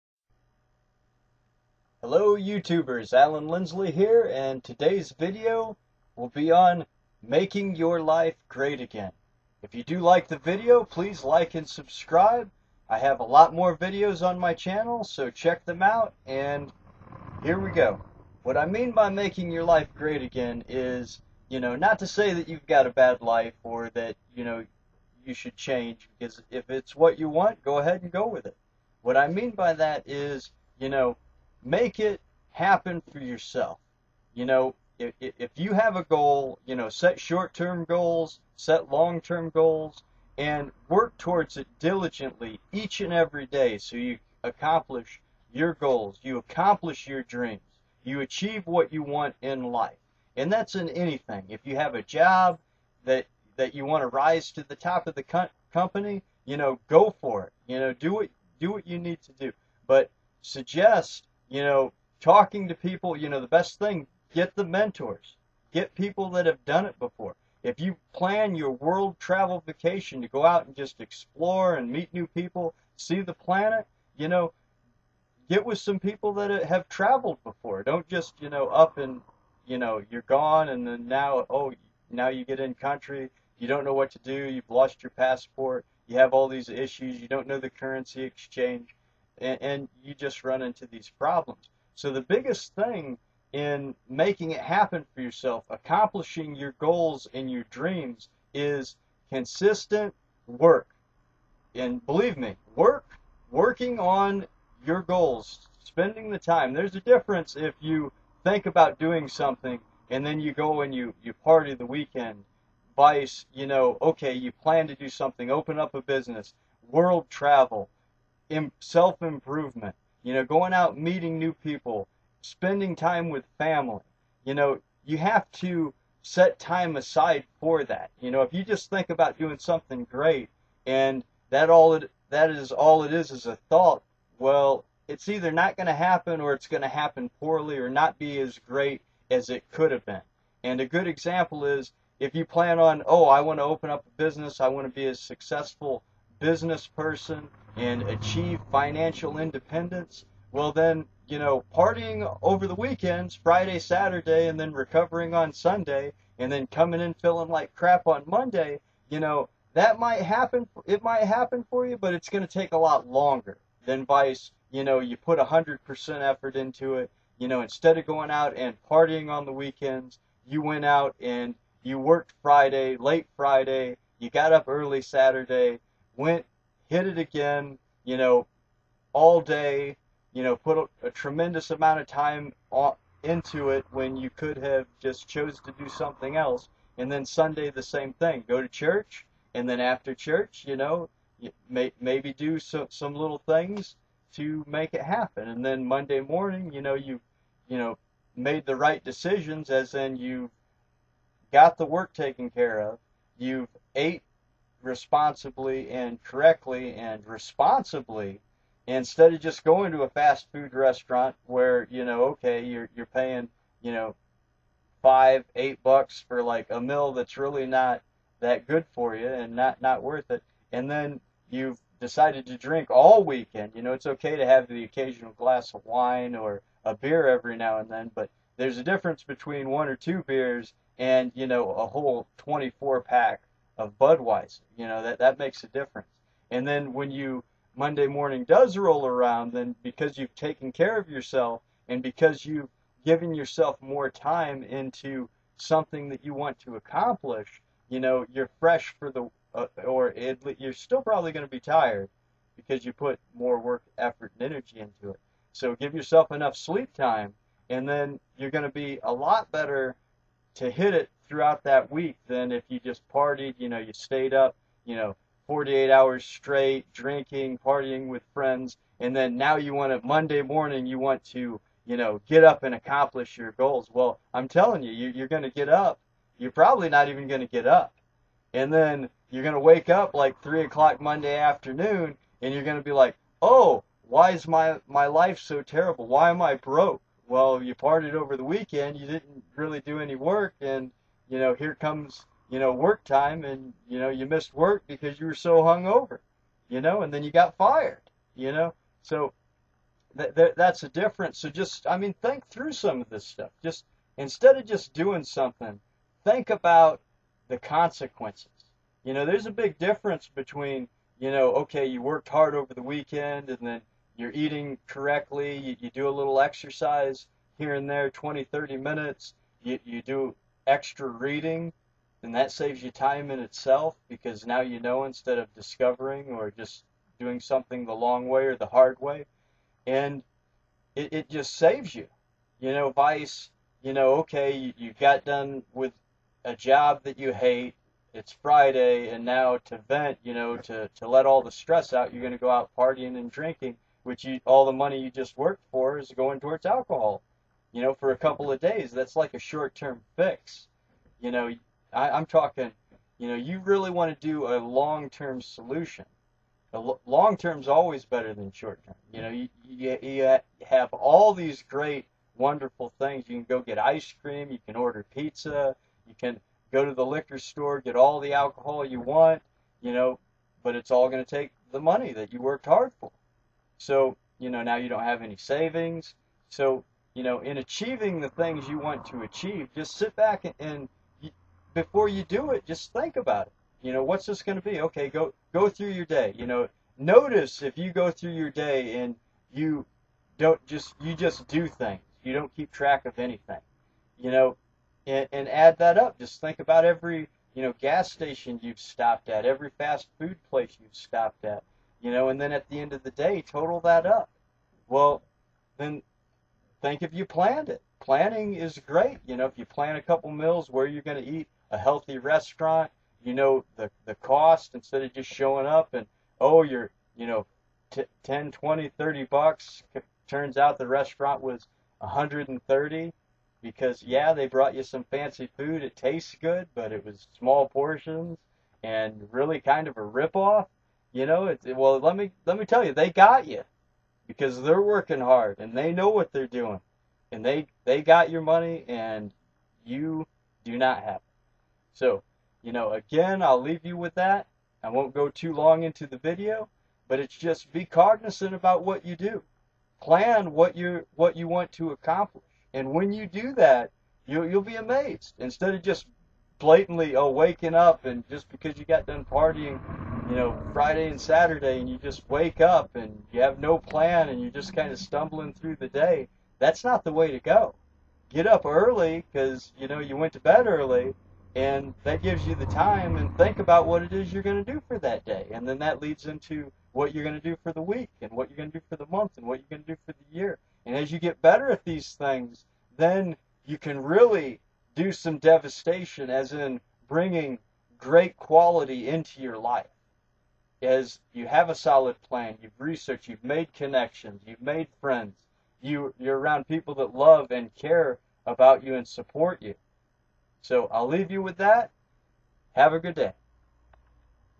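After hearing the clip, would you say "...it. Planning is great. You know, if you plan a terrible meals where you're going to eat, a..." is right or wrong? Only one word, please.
wrong.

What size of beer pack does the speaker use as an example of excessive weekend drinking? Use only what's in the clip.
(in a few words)
24 pack.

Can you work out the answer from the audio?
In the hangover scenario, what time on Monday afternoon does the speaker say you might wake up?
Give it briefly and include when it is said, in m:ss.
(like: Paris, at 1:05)
3 o'clock, at 4:40.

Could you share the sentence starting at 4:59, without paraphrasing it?
So th- th- that's a difference.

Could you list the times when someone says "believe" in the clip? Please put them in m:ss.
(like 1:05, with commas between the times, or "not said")
1:42.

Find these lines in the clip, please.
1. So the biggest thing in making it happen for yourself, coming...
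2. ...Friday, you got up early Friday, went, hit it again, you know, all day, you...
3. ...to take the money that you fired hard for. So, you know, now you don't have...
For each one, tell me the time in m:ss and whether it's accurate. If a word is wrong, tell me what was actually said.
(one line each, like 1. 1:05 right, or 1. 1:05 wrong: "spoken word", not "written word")
1. 1:31 wrong: "accomplishing", not "coming"
2. 2:53 wrong: "Saturday", not "Friday"
3. 6:11 wrong: "worked", not "fired".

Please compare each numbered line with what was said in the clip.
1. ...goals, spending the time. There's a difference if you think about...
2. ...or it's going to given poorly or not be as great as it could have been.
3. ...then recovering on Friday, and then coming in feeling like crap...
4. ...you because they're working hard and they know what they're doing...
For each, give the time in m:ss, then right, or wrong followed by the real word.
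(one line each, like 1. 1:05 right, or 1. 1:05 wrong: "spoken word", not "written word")
1. 1:45 right
2. 2:16 wrong: "happen", not "given"
3. 2:34 wrong: "Sunday", not "Friday"
4. 7:13 right.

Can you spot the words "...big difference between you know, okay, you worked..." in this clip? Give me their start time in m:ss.
5:09.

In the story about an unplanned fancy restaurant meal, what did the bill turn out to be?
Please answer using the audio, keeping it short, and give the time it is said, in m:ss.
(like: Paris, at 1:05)
$130, at 7:01.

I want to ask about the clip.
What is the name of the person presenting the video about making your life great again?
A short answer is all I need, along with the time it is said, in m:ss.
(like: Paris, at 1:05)
Allan Lindsley, at 0:03.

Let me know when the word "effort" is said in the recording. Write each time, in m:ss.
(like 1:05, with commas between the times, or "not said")
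2:46, 4:13.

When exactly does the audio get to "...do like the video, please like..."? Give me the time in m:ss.
0:09.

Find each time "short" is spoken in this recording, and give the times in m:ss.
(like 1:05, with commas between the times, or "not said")
0:37, 5:49, 5:58.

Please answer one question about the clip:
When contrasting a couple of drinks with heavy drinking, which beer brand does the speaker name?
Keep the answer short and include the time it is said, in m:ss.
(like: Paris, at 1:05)
Budweiser, at 3:53.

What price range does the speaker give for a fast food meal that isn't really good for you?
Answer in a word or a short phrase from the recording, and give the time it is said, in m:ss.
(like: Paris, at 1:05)
$5 to $8, at 3:35.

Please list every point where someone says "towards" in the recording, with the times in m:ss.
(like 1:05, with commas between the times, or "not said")
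0:41, 5:46.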